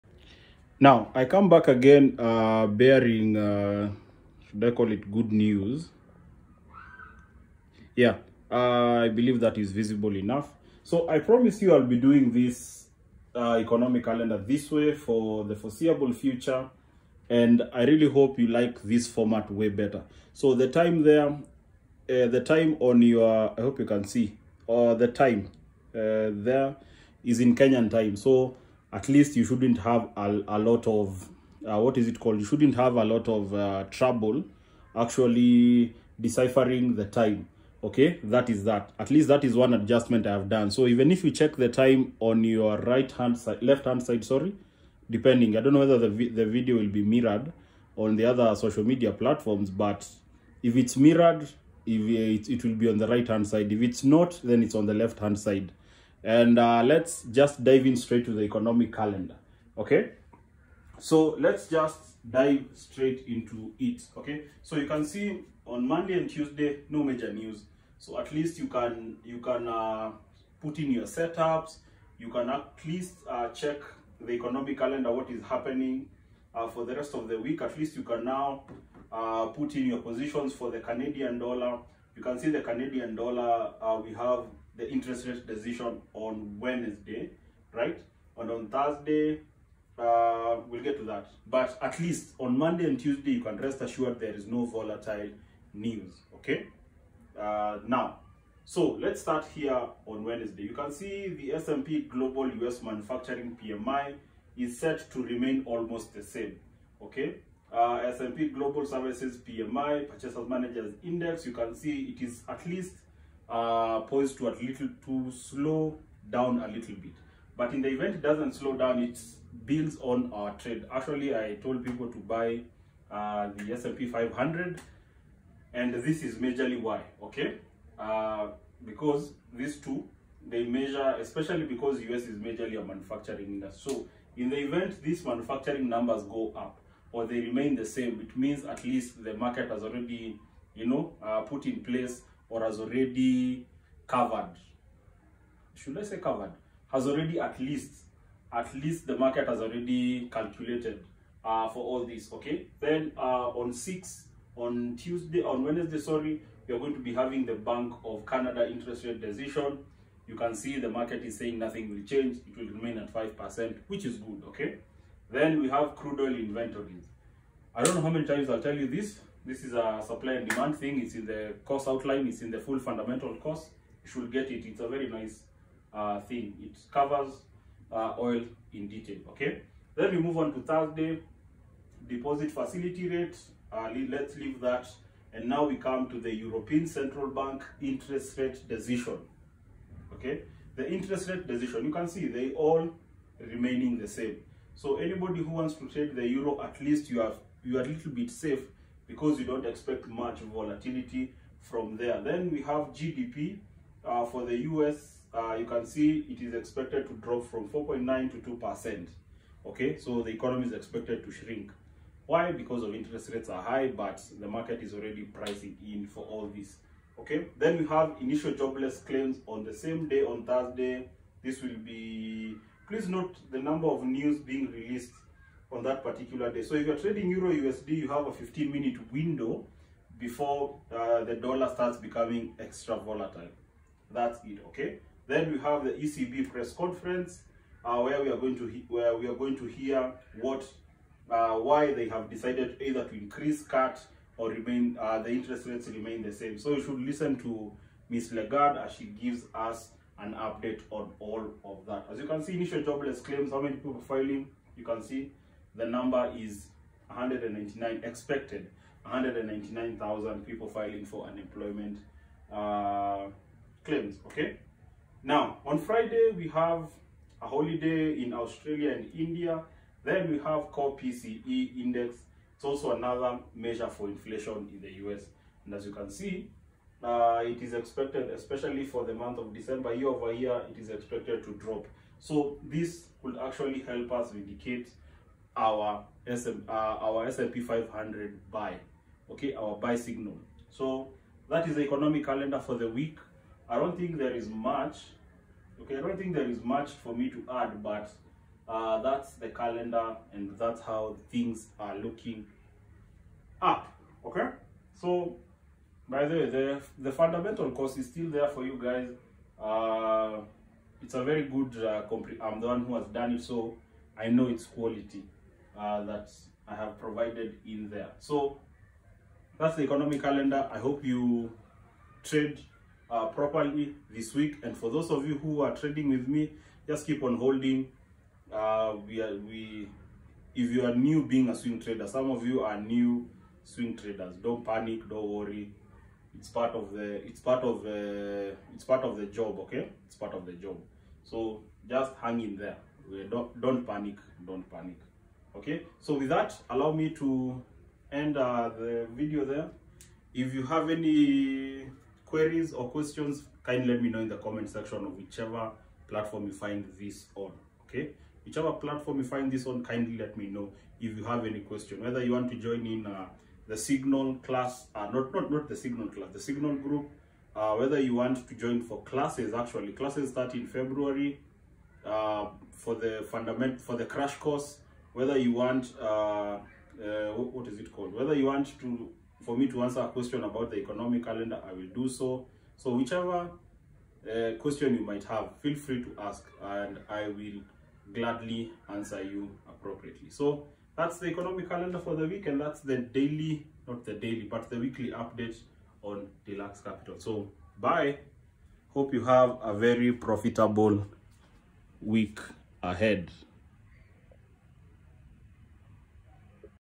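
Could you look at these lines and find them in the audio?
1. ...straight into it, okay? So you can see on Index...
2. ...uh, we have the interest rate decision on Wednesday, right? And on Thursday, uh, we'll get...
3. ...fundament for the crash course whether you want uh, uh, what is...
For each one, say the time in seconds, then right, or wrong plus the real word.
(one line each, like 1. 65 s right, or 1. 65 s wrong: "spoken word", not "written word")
1. 62 s wrong: "Monday", not "Index"
2. 83 s right
3. 373 s right.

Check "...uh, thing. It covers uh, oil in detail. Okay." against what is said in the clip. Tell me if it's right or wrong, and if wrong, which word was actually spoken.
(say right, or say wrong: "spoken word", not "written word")
right.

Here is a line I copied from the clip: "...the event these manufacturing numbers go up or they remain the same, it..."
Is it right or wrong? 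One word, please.
right.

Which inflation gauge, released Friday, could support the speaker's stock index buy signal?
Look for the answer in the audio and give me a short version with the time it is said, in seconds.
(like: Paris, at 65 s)
Core PCE index, at 270 s.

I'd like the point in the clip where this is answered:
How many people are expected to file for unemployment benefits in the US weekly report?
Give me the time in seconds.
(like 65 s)
259 s.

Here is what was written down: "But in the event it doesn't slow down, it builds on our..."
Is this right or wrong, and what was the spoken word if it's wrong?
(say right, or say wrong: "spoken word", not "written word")
right.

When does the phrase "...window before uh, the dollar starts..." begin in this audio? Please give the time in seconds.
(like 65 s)
229 s.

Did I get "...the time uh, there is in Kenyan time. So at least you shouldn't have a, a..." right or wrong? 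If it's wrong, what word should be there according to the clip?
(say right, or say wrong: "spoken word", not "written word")
right.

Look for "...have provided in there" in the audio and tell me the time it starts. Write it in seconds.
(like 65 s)
316 s.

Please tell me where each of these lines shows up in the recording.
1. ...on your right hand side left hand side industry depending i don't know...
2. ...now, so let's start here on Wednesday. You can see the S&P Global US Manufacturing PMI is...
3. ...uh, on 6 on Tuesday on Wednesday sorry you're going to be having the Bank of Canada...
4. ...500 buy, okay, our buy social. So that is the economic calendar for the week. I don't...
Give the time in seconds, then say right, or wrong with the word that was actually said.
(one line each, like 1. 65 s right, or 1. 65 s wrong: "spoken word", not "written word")
1. 42 s wrong: "sorry", not "industry"
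2. 97 s right
3. 153 s right
4. 287 s wrong: "signal", not "social".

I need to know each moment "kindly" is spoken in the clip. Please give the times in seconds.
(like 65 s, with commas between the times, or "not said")
353 s, 359 s.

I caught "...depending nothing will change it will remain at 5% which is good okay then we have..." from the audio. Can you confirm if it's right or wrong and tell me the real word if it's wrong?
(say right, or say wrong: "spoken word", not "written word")
wrong: "saying", not "depending".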